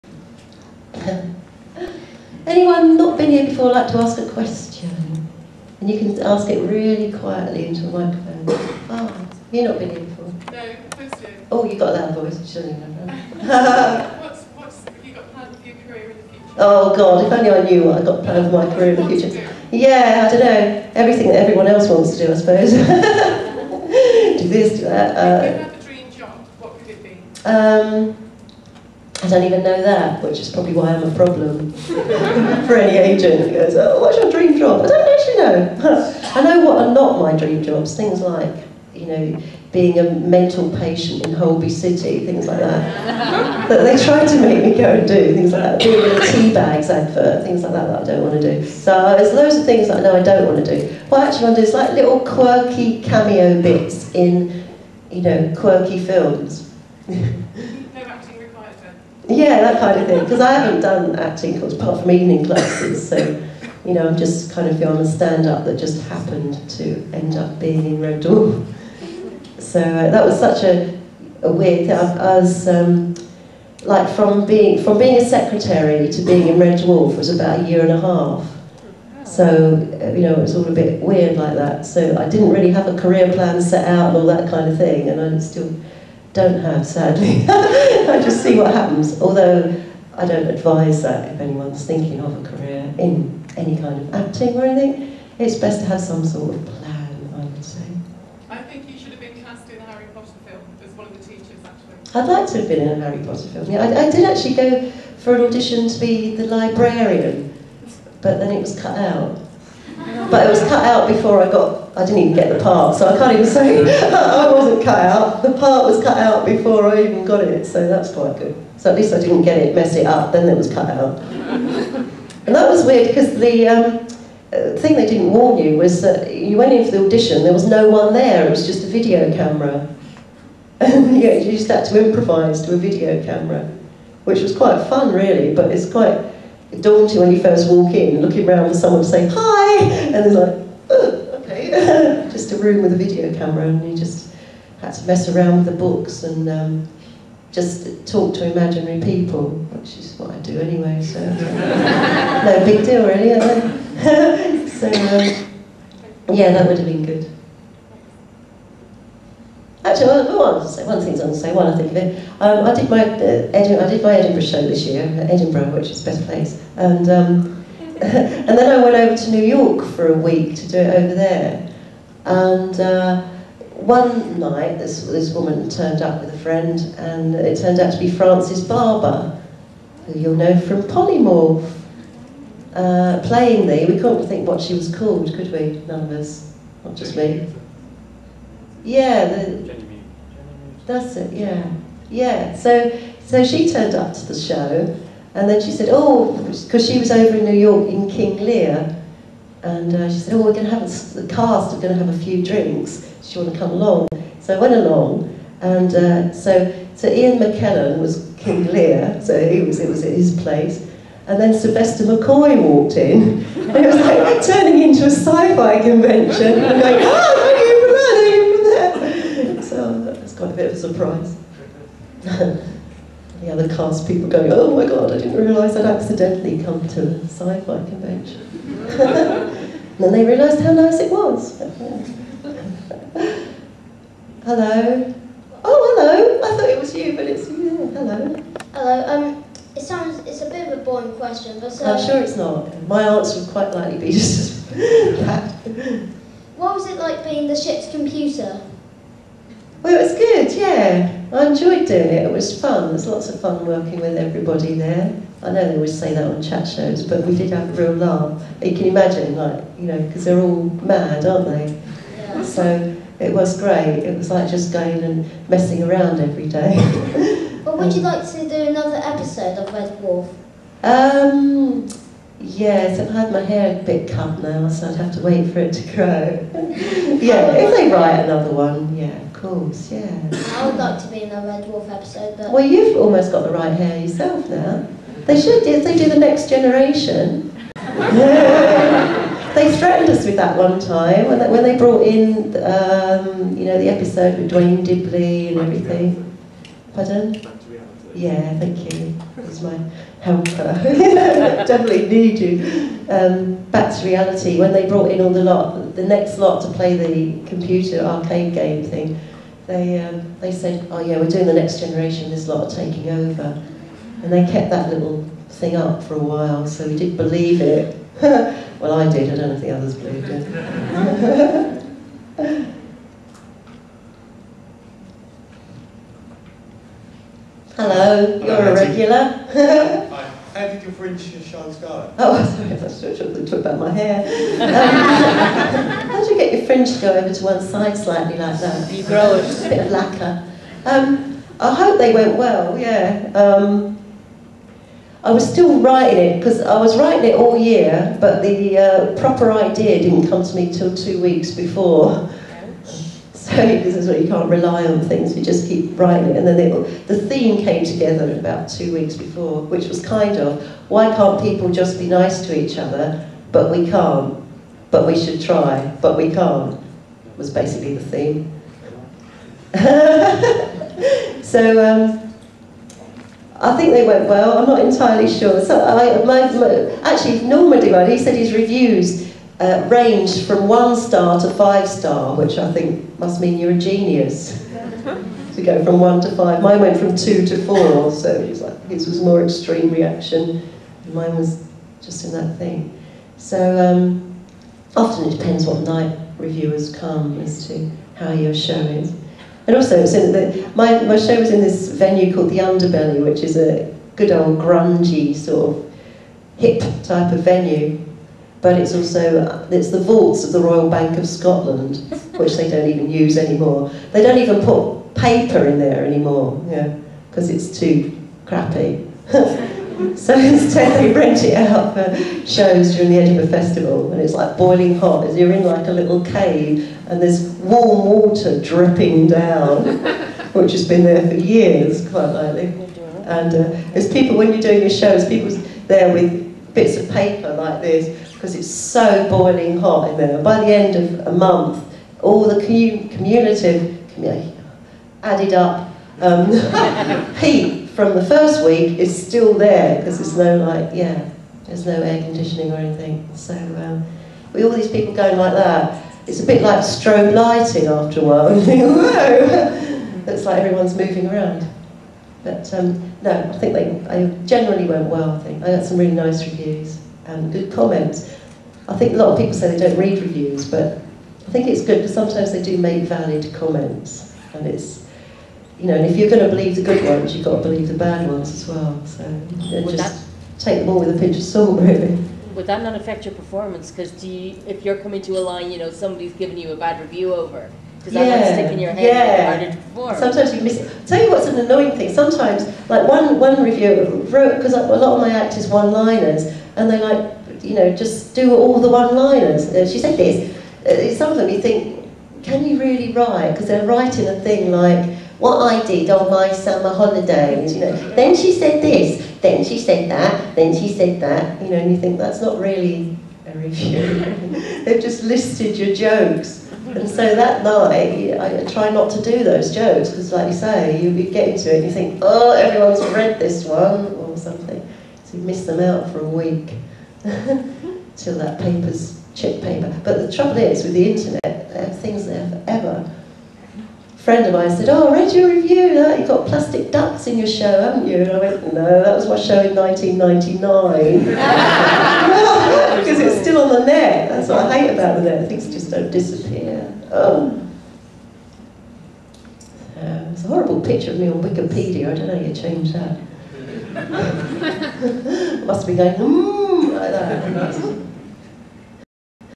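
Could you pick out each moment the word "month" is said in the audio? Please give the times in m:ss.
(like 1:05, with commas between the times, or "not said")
7:21.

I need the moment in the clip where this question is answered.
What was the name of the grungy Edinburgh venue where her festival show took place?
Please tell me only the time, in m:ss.
6:42.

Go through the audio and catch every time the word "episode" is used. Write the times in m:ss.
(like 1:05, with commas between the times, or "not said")
4:29, 4:41, 4:53.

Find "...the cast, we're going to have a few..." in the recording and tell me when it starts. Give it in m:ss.
3:21.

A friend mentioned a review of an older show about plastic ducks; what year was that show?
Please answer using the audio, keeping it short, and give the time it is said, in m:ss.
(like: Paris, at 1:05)
1999, at 8:59.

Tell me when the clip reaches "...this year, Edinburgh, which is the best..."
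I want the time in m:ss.
2:44.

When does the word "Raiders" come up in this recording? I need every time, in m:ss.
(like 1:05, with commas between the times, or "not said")
not said.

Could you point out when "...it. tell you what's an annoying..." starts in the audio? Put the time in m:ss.
8:10.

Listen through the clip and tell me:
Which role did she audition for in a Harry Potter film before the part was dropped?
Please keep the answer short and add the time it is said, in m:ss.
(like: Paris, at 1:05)
The librarian, at 1:46.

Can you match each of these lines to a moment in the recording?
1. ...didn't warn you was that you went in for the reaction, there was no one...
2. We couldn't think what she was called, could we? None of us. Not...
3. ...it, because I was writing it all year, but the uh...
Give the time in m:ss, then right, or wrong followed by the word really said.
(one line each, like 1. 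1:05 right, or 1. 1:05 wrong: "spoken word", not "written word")
1. 2:05 wrong: "audition", not "reaction"
2. 3:03 right
3. 5:46 right.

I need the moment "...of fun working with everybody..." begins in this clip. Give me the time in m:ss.
4:13.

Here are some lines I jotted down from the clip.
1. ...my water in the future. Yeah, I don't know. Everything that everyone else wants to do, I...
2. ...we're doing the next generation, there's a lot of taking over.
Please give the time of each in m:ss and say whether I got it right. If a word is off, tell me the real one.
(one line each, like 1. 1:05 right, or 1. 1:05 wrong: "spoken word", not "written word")
1. 0:18 wrong: "career", not "water"
2. 5:11 right.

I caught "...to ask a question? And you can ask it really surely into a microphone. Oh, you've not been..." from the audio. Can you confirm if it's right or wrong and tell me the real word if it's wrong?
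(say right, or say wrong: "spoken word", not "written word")
wrong: "quietly", not "surely".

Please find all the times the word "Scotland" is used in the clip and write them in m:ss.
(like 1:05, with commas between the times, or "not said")
6:51.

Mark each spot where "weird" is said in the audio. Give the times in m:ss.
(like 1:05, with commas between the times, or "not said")
1:11, 1:21, 2:02.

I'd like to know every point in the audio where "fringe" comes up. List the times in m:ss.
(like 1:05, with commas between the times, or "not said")
5:30, 5:36.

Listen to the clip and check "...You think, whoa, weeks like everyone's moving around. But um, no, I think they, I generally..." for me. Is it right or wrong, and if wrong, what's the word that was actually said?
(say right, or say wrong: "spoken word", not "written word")
wrong: "looks", not "weeks".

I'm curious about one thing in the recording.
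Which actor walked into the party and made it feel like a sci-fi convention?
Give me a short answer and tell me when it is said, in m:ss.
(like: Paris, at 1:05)
Sylvester McCoy, at 3:31.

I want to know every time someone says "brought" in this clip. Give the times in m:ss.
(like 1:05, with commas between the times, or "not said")
4:51, 5:04.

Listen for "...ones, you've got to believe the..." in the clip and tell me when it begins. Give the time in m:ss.
7:57.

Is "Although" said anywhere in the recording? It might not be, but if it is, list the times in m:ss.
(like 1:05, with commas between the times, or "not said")
1:29.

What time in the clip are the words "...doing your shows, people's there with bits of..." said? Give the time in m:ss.
7:14.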